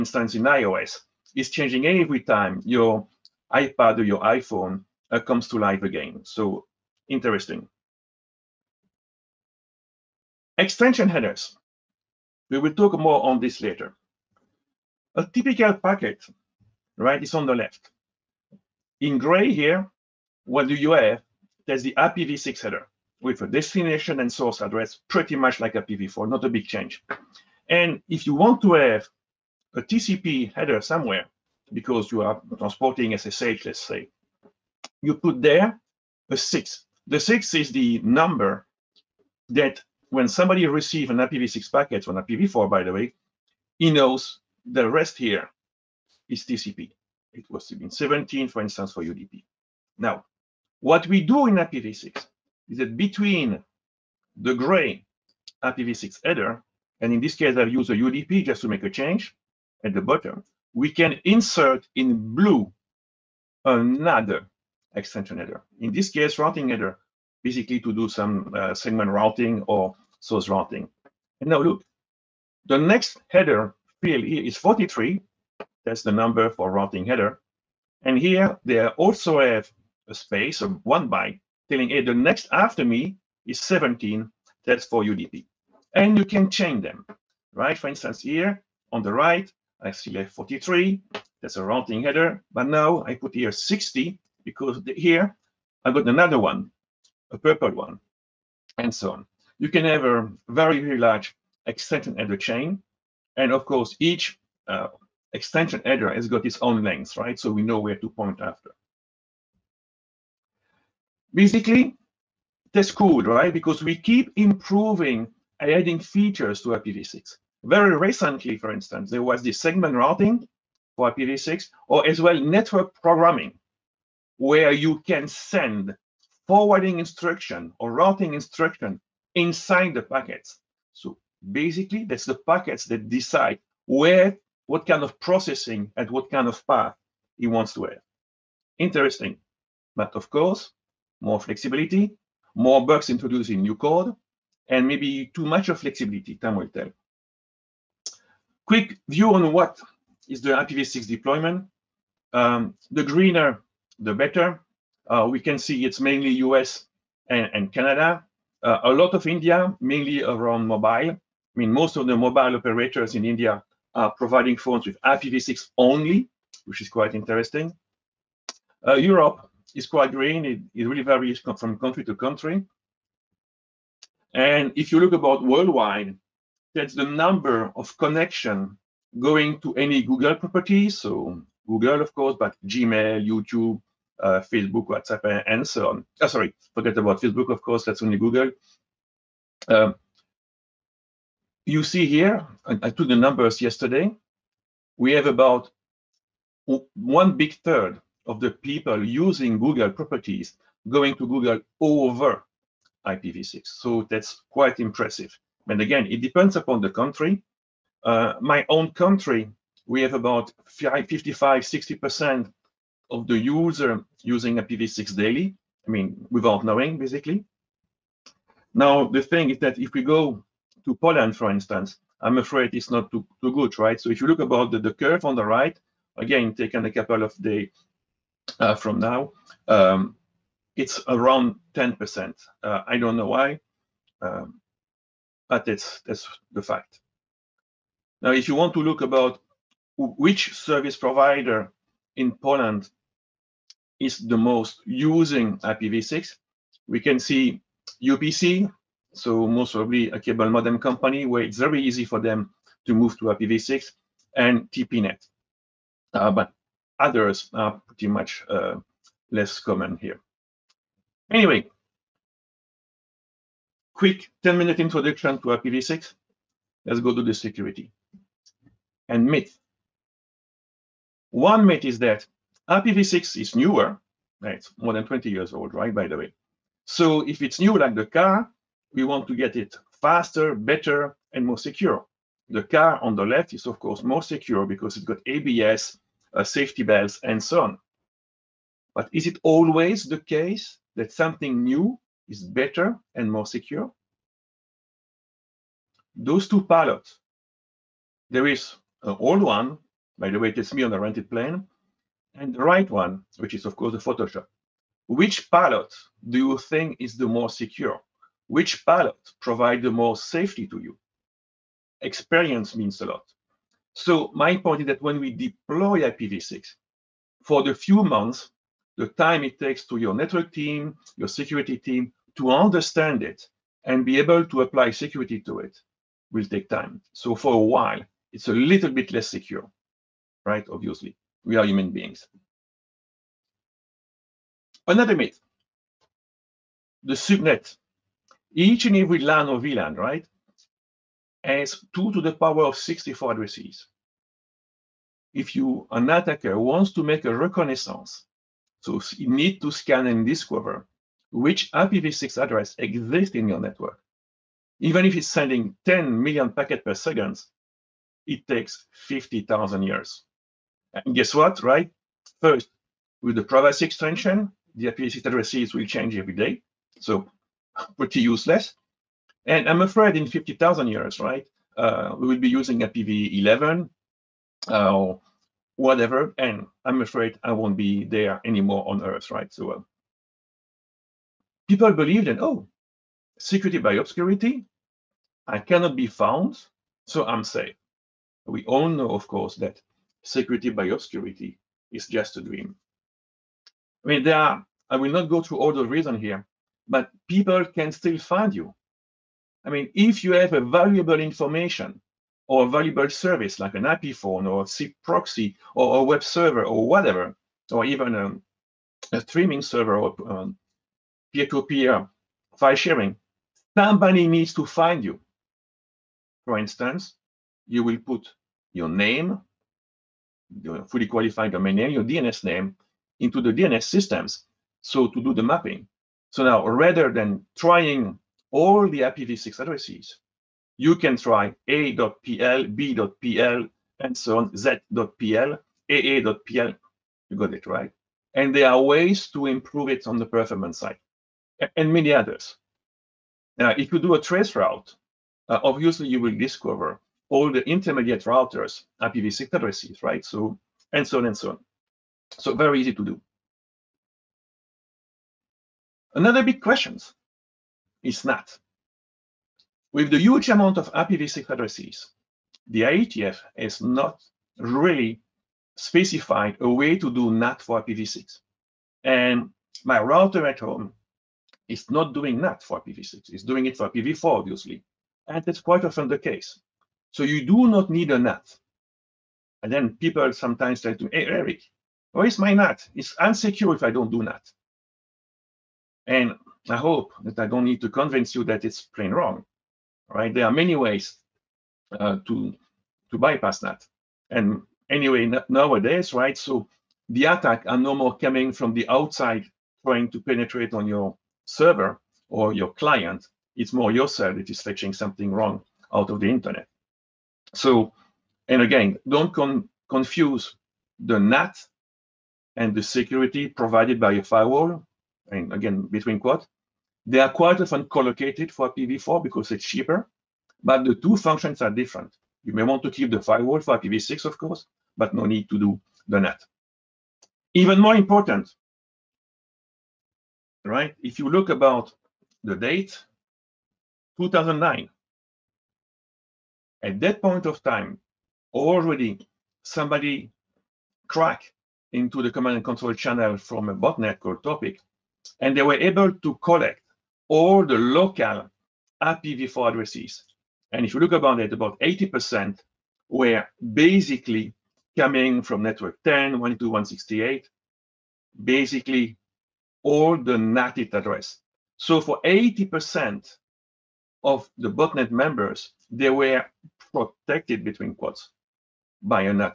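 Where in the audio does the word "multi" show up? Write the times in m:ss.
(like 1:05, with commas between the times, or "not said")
not said.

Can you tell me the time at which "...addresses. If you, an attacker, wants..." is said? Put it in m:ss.
5:43.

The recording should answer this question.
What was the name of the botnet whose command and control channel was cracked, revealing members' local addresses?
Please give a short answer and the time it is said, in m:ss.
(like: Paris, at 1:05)
Torpig, at 9:04.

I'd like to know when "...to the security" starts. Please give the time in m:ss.
4:27.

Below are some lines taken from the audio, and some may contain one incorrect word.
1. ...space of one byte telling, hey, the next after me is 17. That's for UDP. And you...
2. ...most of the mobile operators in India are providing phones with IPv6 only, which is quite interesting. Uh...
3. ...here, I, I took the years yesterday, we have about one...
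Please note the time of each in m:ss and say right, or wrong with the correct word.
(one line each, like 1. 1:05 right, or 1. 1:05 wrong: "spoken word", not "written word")
1. 1:20 right
2. 2:41 right
3. 3:12 wrong: "numbers", not "years".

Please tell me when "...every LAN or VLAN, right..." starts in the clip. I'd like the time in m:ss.
5:38.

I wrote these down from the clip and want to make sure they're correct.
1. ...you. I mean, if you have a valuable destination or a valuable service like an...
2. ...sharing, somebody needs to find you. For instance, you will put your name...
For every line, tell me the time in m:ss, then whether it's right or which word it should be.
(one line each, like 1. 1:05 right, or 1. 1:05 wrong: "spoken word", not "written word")
1. 6:38 wrong: "information", not "destination"
2. 6:52 right.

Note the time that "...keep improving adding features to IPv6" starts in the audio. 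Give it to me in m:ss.
1:53.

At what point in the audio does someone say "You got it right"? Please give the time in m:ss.
7:17.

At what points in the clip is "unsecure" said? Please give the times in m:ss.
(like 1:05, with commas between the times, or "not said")
8:03.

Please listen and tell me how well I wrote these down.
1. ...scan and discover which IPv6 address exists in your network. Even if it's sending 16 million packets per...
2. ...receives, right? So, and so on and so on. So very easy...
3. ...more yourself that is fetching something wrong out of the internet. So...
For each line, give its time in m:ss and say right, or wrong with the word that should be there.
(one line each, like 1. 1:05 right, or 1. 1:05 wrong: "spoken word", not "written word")
1. 5:49 wrong: "10", not "16"
2. 7:29 wrong: "addresses", not "receives"
3. 8:23 right.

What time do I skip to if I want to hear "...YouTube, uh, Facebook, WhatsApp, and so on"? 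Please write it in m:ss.
3:03.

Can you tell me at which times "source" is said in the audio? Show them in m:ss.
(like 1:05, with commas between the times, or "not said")
0:24, 1:10.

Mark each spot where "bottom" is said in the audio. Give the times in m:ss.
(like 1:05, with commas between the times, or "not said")
1:00.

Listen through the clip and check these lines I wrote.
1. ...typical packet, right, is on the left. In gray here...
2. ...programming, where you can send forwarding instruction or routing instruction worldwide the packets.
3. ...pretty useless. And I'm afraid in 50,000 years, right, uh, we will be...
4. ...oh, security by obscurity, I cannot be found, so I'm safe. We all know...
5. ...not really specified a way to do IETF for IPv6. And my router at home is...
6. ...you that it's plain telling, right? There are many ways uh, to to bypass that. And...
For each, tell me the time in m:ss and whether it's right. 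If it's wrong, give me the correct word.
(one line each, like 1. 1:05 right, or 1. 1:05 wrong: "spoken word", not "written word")
1. 0:15 right
2. 2:03 wrong: "inside", not "worldwide"
3. 6:07 right
4. 6:22 right
5. 7:43 wrong: "NAT", not "IETF"
6. 8:08 wrong: "wrong", not "telling".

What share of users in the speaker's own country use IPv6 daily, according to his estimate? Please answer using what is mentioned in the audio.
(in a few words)
55 to 60%.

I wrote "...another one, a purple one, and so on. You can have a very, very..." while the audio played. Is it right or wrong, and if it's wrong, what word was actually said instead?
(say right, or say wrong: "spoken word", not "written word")
right.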